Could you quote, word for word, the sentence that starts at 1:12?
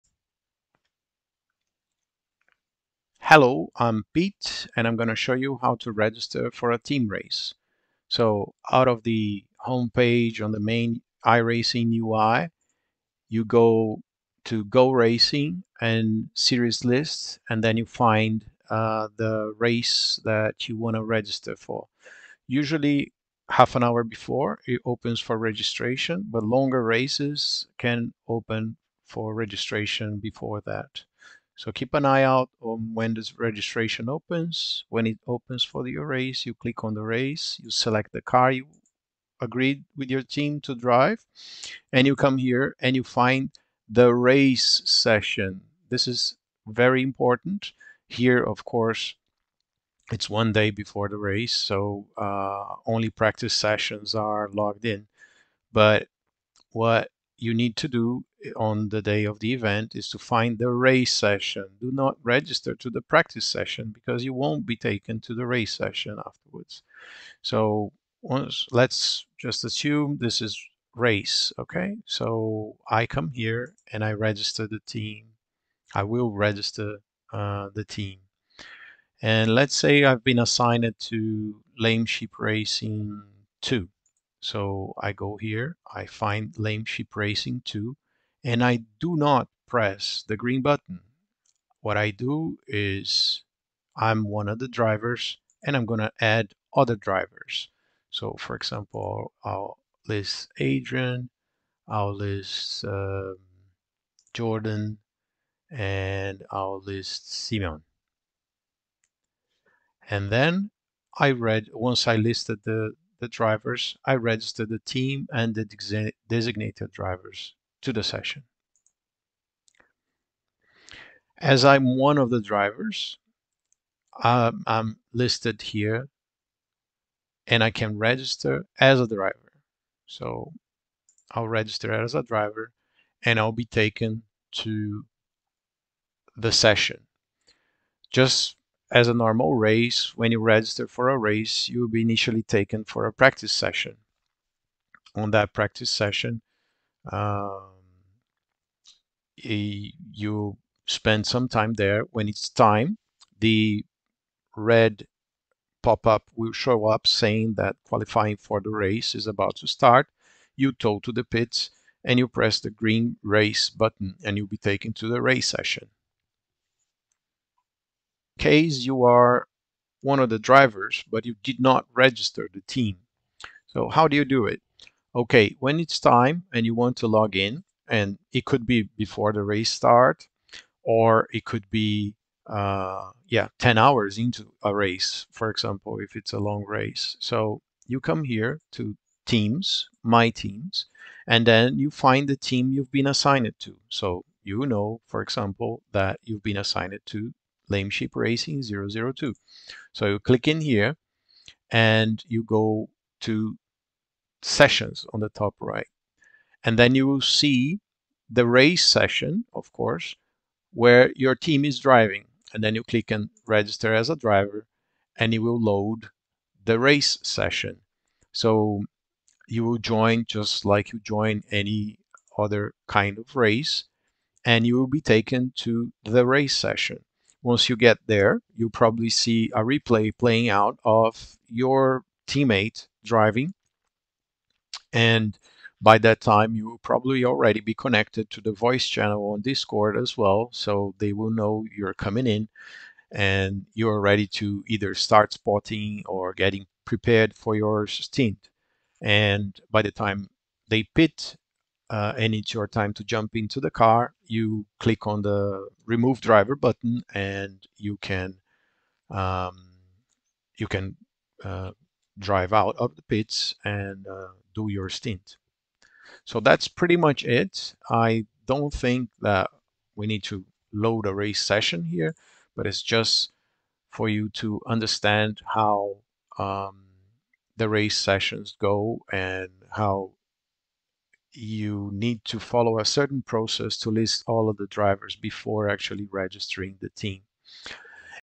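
So I come here and I register the team.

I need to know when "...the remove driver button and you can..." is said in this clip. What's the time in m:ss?
4:15.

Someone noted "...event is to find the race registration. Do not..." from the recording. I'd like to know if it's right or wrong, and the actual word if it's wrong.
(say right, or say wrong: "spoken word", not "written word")
wrong: "session", not "registration".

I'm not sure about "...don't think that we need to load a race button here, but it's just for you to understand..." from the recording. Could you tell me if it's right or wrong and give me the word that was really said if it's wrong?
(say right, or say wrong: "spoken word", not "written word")
wrong: "session", not "button".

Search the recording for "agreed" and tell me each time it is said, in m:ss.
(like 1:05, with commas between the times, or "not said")
0:39.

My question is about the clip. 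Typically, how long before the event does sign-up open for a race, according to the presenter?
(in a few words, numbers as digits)
Half an hour.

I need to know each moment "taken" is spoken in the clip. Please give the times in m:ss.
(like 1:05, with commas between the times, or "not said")
1:04, 2:13, 2:22, 2:44, 3:45.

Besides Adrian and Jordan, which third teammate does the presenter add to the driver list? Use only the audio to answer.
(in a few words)
Simon.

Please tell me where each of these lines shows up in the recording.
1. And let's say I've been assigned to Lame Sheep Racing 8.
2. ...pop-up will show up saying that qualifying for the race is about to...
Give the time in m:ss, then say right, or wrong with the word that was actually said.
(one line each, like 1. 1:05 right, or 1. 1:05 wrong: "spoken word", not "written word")
1. 1:19 wrong: "2", not "8"
2. 2:35 right.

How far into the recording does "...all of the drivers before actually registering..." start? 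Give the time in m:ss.
4:44.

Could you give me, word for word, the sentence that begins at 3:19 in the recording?
So you click in here and you go to sessions on the top right.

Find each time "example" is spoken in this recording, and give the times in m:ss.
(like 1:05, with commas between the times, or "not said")
1:38, 3:05, 3:15.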